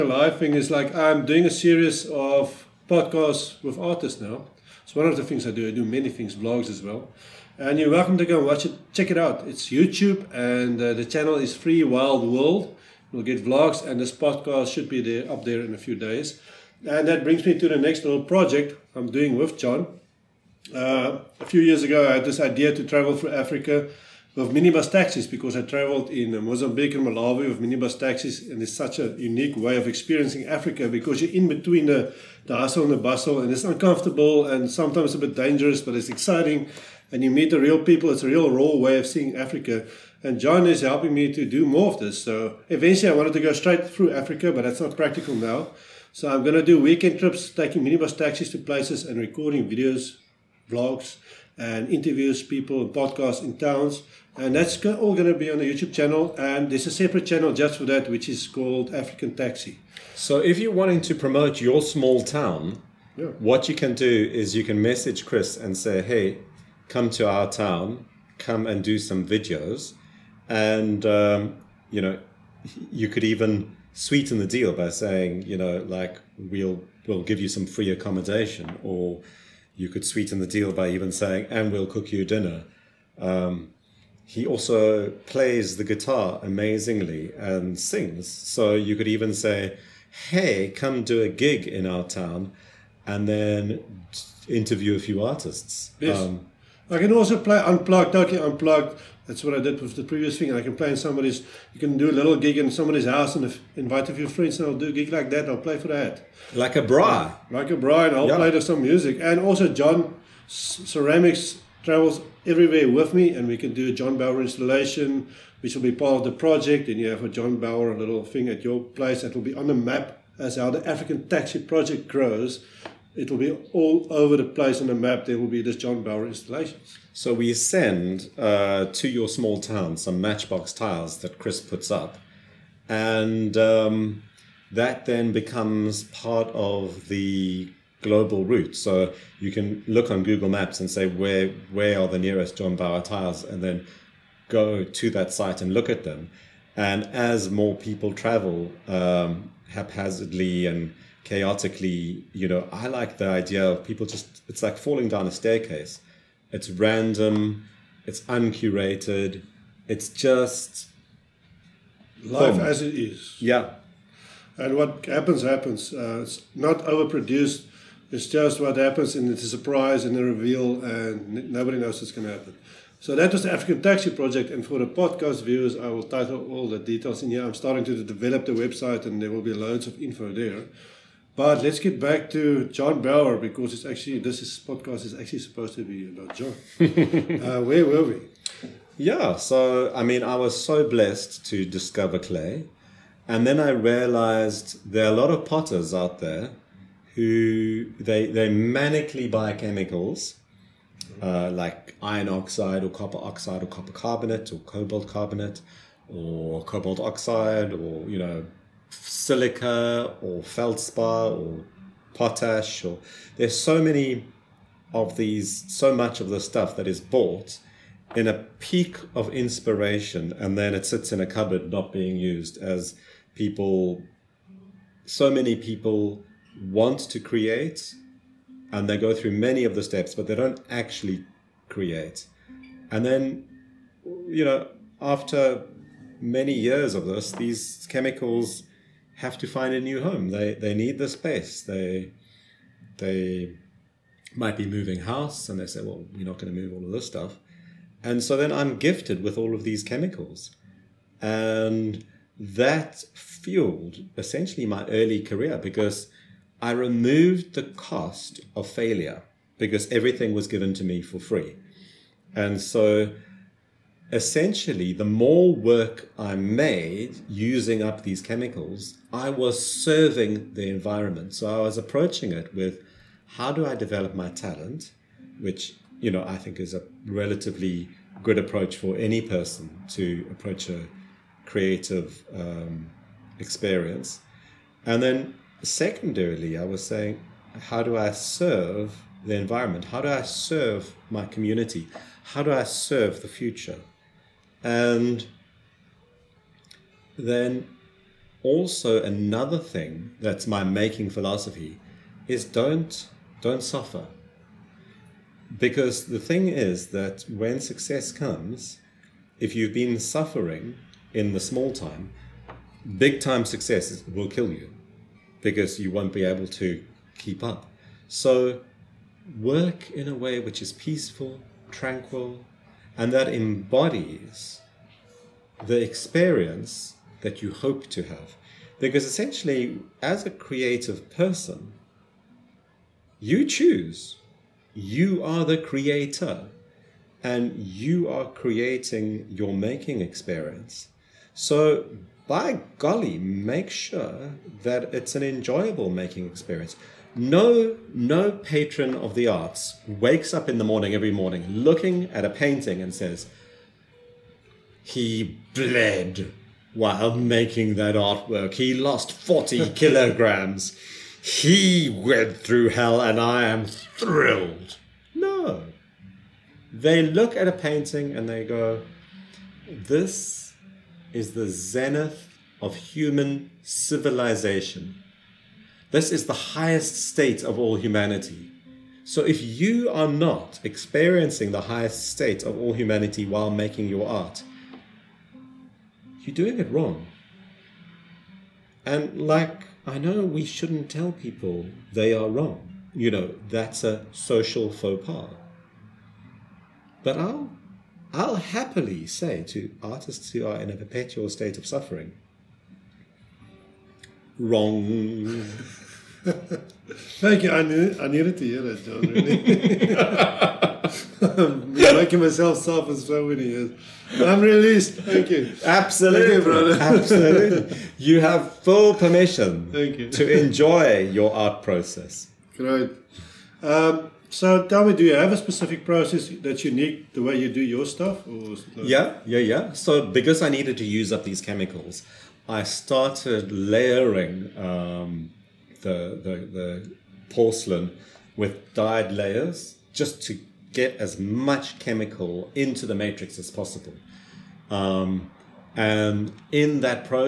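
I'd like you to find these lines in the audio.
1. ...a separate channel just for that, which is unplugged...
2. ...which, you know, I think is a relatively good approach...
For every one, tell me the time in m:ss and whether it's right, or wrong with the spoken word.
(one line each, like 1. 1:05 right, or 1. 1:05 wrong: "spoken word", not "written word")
1. 0:56 wrong: "called", not "unplugged"
2. 4:35 right.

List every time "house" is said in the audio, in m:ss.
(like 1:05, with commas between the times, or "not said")
1:43, 4:05.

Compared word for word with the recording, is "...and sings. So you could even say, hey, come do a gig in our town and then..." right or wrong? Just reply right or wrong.
right.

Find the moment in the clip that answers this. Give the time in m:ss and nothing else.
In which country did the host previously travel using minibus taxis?
0:26.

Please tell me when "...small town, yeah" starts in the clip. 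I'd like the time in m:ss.
1:01.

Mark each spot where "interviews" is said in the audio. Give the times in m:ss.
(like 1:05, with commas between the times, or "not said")
0:51, 1:34.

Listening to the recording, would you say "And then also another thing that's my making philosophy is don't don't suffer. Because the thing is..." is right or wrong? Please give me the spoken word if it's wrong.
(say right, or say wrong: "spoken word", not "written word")
right.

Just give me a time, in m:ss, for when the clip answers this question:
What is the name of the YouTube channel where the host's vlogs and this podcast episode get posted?
0:11.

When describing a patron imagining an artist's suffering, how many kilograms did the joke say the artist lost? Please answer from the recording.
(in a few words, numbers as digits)
40 kilograms.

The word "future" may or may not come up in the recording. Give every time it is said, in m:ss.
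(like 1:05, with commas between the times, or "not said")
4:53.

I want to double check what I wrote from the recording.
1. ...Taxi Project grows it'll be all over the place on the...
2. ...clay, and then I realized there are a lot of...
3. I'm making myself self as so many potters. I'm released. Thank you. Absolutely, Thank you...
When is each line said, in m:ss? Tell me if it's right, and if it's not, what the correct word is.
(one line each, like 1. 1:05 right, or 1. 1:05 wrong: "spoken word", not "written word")
1. 2:01 right
2. 3:12 right
3. 6:51 wrong: "years", not "potters".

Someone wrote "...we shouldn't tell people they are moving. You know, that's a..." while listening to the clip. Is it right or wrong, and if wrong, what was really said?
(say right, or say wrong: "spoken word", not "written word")
wrong: "wrong", not "moving".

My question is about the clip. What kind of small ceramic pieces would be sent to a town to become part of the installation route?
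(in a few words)
matchbox tiles.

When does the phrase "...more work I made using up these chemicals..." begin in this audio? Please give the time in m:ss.
4:25.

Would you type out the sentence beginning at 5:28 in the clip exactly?
Because essentially, as a creative person, you choose.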